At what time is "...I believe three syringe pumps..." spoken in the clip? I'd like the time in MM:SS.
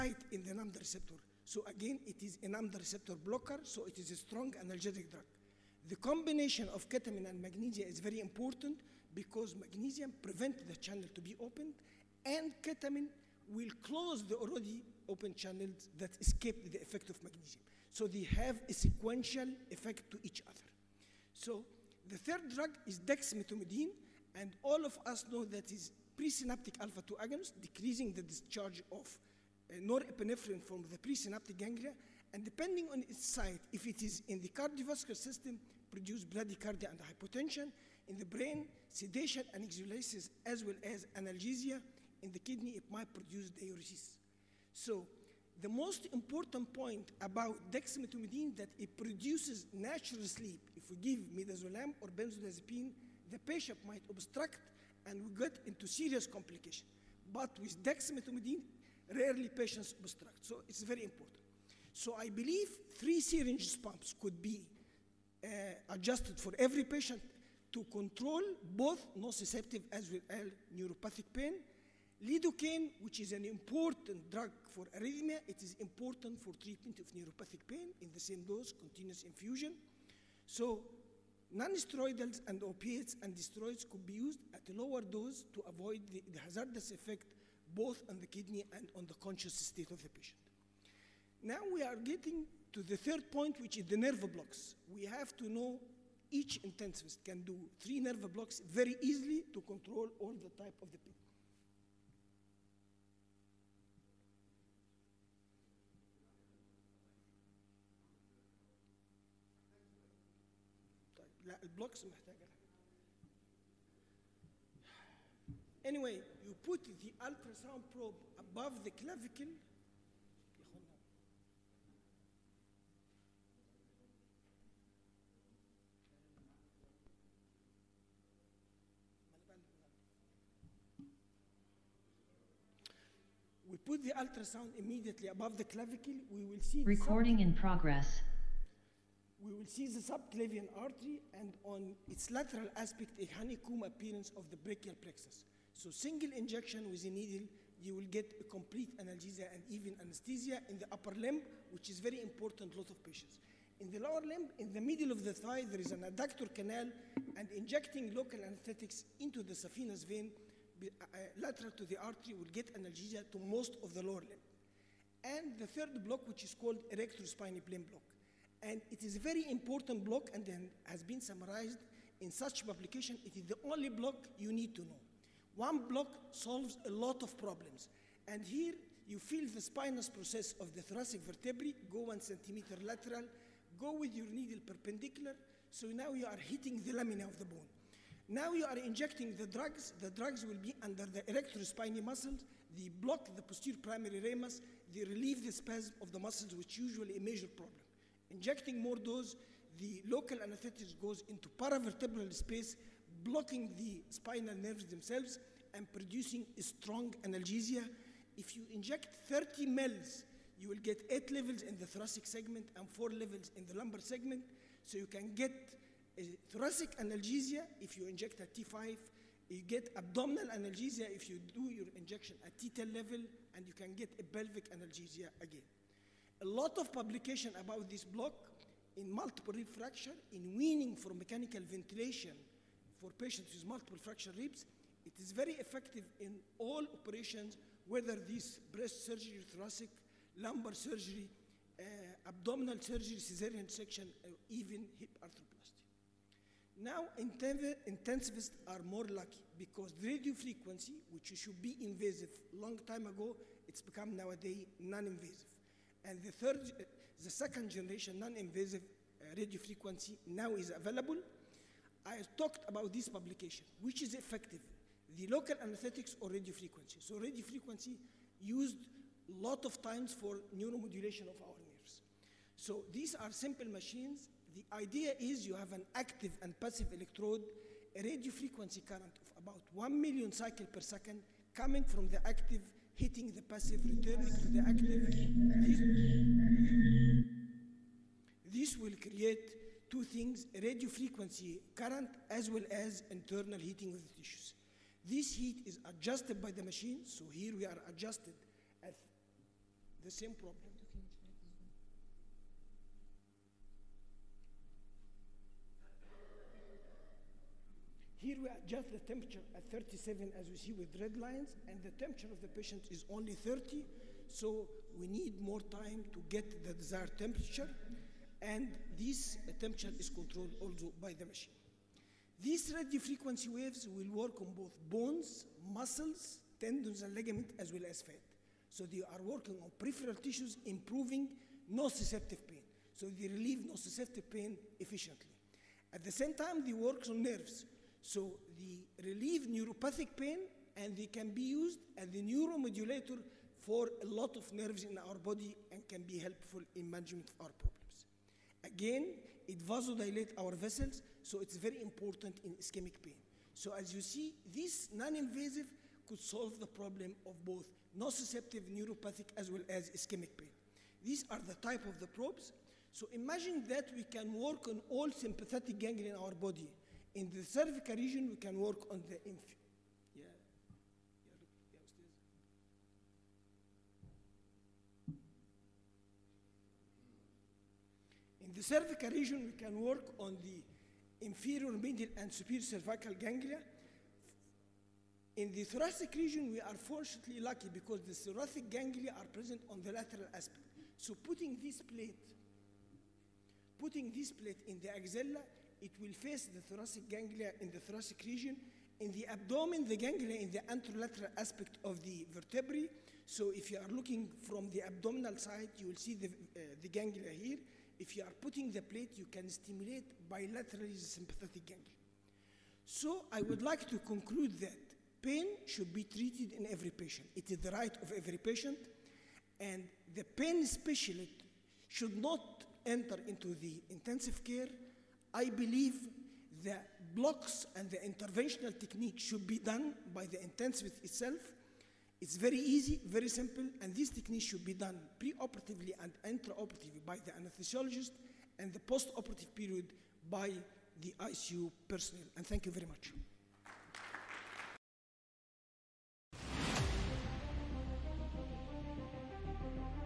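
01:02.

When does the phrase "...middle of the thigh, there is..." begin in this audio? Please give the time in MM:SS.
02:34.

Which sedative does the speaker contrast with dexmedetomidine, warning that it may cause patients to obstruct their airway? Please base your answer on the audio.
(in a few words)
midazolam.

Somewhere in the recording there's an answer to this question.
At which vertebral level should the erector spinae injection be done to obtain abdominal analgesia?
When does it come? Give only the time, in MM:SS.
03:42.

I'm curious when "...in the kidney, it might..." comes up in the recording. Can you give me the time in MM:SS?
00:42.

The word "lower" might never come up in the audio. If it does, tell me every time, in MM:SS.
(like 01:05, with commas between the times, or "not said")
01:24, 02:33, 02:44.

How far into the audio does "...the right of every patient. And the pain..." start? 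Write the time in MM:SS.
06:57.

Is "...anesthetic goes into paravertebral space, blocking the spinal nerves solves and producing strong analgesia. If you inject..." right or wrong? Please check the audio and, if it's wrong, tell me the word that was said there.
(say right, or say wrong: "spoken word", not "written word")
wrong: "themselves", not "solves".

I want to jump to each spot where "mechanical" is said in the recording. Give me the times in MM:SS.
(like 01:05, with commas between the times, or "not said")
03:51.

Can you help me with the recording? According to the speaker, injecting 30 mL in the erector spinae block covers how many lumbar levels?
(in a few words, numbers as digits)
4.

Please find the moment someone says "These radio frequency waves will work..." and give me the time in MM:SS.
05:22.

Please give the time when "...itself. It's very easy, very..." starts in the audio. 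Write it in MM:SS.
07:11.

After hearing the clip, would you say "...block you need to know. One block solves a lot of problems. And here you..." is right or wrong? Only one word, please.
right.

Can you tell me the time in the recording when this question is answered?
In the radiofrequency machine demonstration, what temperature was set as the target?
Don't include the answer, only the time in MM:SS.
05:09.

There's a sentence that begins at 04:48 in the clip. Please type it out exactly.
This will create two things, radio frequency current as well as internal heating of the tissues.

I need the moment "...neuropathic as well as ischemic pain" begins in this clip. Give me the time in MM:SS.
05:58.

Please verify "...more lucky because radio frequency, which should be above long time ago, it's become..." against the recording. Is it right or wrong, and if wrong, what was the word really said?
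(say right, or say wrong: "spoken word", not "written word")
wrong: "invasive", not "above".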